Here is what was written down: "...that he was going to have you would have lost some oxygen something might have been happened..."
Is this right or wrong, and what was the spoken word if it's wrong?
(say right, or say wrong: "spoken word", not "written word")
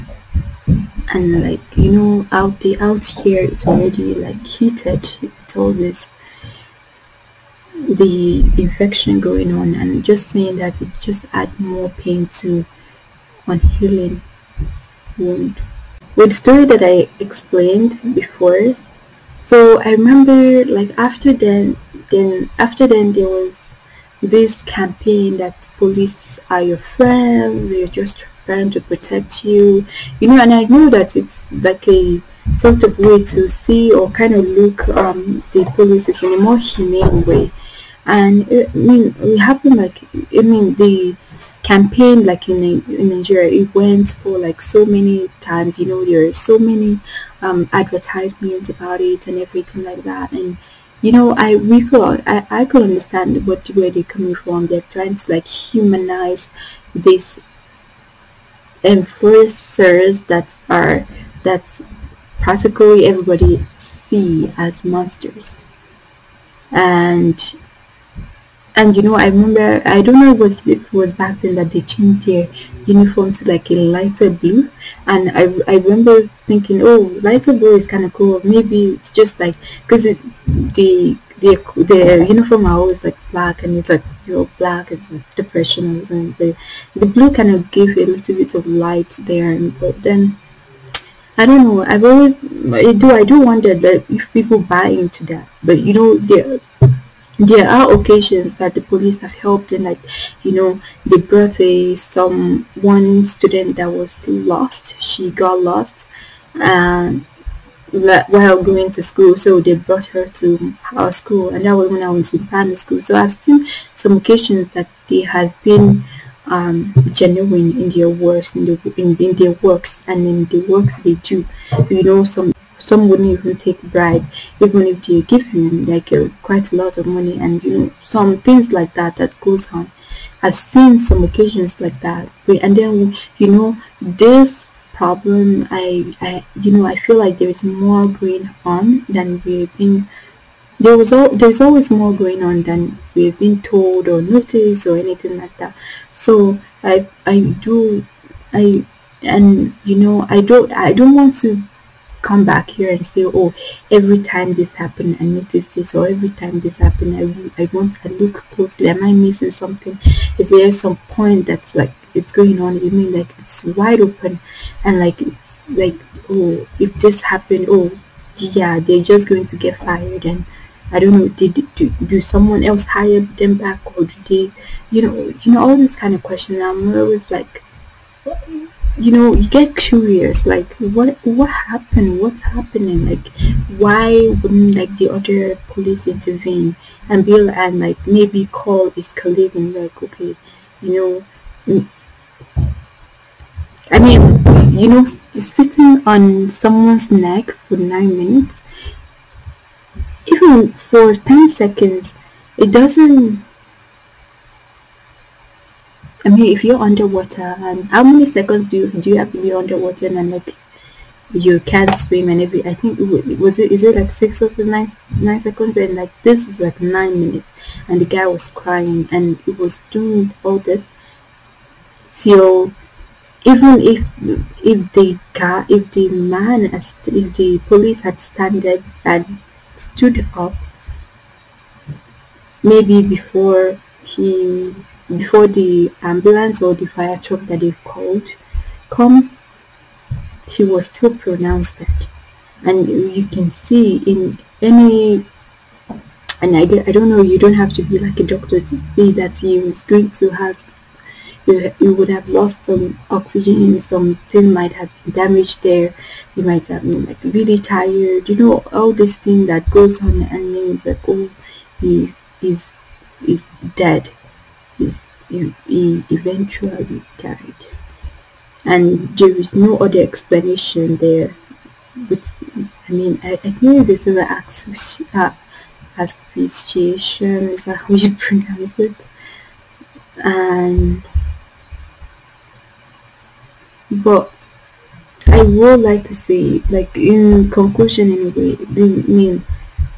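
wrong: "damaged", not "happened".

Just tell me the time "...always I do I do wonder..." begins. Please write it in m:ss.
1:32.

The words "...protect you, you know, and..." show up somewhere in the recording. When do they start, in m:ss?
0:28.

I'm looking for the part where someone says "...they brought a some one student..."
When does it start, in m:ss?
1:41.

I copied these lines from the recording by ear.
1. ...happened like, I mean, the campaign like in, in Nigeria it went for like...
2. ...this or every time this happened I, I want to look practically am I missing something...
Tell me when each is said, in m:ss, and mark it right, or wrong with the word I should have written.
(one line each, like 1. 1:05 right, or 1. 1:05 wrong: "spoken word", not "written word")
1. 0:39 right
2. 2:35 wrong: "closely", not "practically".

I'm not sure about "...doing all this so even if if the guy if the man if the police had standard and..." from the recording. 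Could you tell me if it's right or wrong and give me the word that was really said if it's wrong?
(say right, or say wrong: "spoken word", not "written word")
right.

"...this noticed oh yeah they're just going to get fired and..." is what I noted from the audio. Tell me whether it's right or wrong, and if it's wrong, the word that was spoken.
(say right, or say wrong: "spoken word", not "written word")
wrong: "happened", not "noticed".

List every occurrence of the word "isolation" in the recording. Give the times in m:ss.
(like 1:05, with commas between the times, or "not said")
not said.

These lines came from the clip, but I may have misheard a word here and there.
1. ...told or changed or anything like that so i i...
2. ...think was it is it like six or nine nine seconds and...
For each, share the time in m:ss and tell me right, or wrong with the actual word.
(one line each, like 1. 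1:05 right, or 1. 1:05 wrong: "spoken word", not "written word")
1. 2:23 wrong: "noticed", not "changed"
2. 3:32 right.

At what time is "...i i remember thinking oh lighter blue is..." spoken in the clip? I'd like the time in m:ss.
1:15.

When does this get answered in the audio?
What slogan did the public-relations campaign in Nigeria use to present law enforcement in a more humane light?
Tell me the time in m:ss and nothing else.
0:25.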